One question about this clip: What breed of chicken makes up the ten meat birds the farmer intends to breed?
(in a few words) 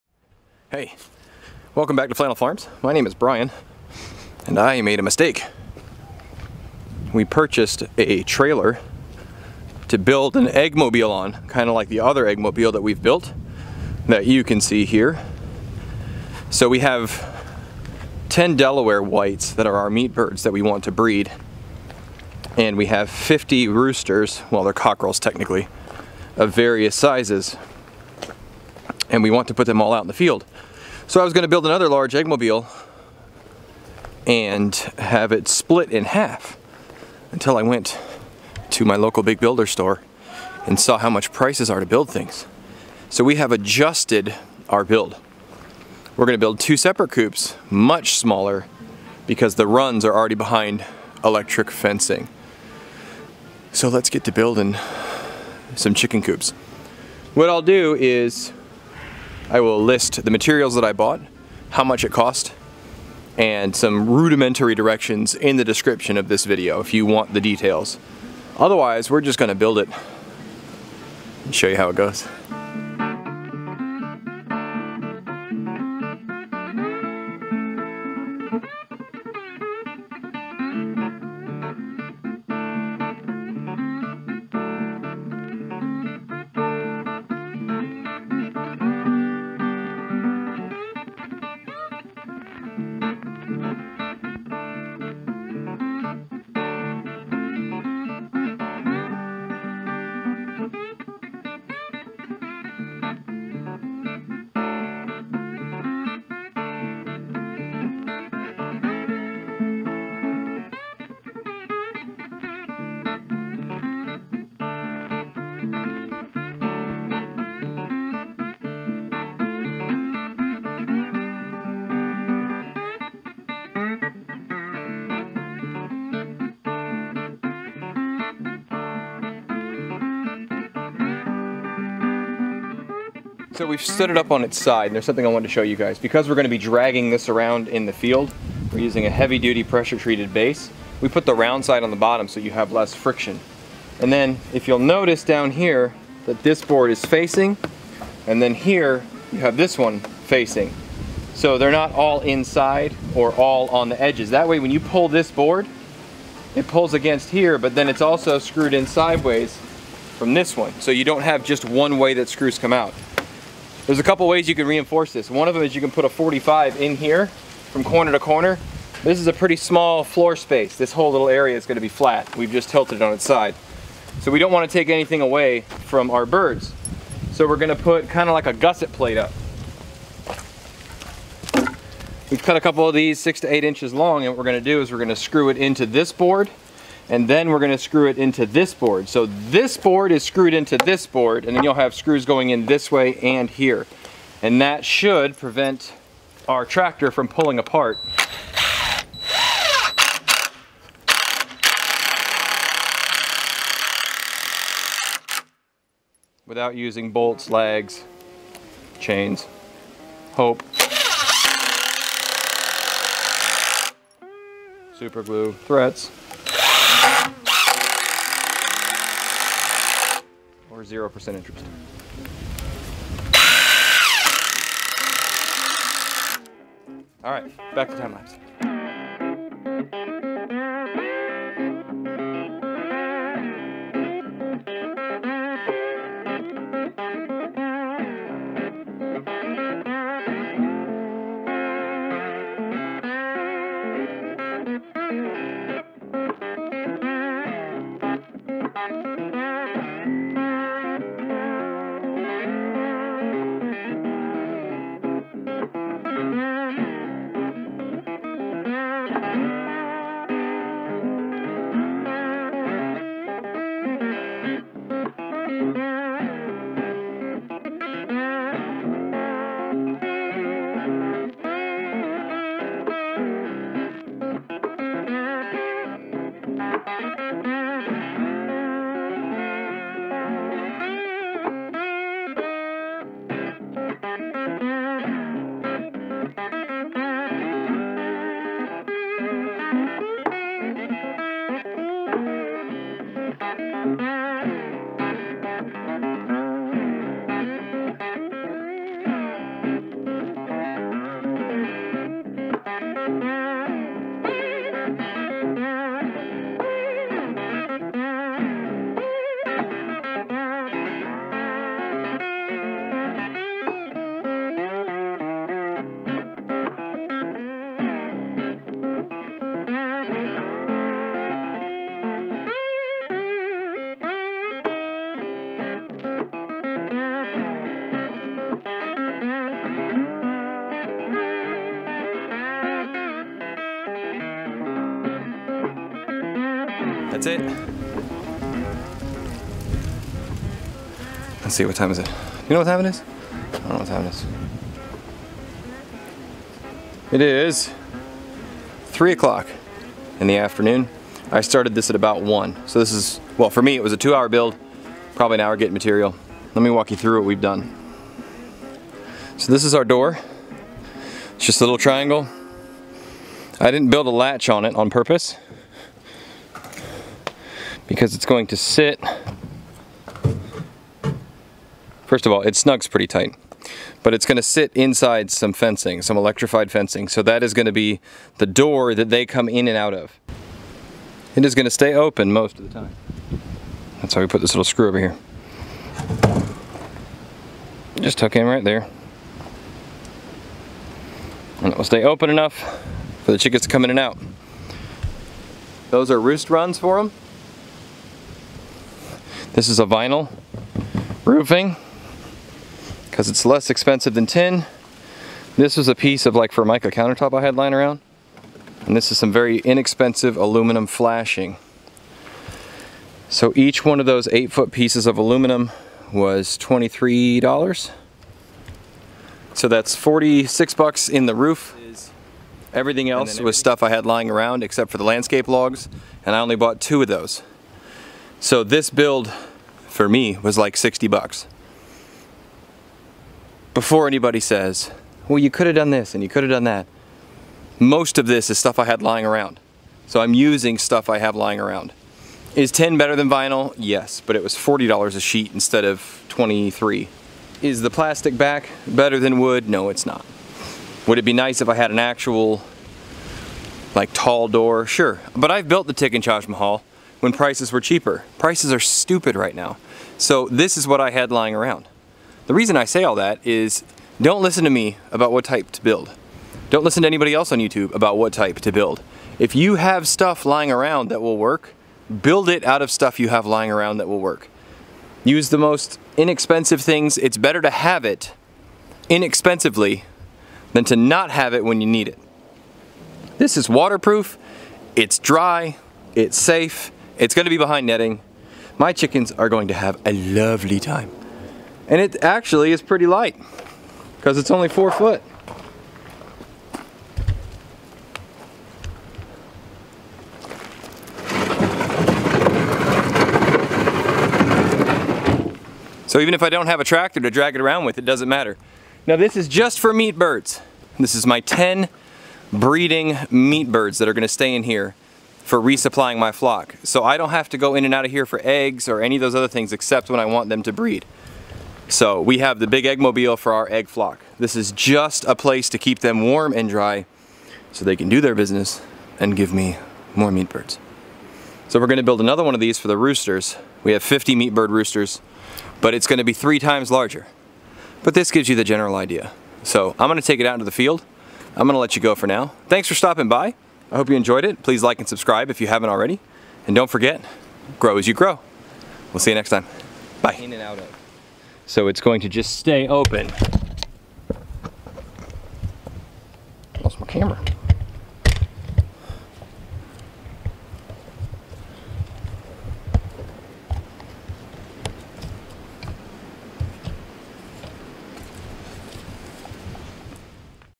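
Delaware whites.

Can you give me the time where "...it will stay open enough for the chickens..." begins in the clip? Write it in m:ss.
6:31.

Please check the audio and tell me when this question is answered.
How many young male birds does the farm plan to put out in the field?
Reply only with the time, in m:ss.
0:23.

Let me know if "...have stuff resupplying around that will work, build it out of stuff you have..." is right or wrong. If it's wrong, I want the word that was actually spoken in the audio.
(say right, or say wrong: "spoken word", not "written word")
wrong: "lying", not "resupplying".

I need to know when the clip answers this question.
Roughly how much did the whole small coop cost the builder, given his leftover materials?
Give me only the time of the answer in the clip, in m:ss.
7:10.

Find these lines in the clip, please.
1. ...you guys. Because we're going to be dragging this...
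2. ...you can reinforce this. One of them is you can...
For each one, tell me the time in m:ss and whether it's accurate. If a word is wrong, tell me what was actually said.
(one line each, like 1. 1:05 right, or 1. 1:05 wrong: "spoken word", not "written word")
1. 2:15 right
2. 2:44 right.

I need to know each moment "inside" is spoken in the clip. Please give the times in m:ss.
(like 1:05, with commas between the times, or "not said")
2:32, 6:14.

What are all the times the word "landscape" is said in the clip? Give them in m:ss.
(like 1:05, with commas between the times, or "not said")
7:05.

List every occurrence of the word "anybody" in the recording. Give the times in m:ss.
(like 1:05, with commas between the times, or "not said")
7:14, 7:47.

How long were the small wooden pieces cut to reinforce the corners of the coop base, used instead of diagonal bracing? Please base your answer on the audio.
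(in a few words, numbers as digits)
6 to 8 inches.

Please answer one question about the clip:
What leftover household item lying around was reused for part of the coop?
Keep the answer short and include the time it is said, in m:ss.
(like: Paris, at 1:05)
Formica countertop, at 6:46.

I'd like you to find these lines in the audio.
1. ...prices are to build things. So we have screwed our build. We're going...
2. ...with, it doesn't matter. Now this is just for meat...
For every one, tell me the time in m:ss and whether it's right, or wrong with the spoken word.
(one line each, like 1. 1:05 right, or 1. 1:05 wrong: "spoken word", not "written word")
1. 0:41 wrong: "adjusted", not "screwed"
2. 8:27 right.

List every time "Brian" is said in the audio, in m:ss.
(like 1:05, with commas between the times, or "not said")
0:03.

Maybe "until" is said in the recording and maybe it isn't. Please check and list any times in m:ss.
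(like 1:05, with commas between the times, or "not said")
0:37.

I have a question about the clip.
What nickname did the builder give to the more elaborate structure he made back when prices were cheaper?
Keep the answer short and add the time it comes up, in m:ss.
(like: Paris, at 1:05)
Tick Taj Mahal, at 7:35.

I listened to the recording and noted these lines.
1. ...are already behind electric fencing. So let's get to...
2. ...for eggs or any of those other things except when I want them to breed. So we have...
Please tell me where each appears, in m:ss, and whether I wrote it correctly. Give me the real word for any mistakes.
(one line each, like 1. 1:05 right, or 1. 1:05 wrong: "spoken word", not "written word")
1. 0:50 right
2. 8:38 right.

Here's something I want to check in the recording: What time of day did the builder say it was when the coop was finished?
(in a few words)
3 o'clock.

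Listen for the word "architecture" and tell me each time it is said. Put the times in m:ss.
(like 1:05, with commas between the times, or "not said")
not said.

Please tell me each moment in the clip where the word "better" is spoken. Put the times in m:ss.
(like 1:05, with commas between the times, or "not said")
7:22, 7:28, 7:57.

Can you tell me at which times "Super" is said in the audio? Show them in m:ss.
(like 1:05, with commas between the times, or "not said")
3:34.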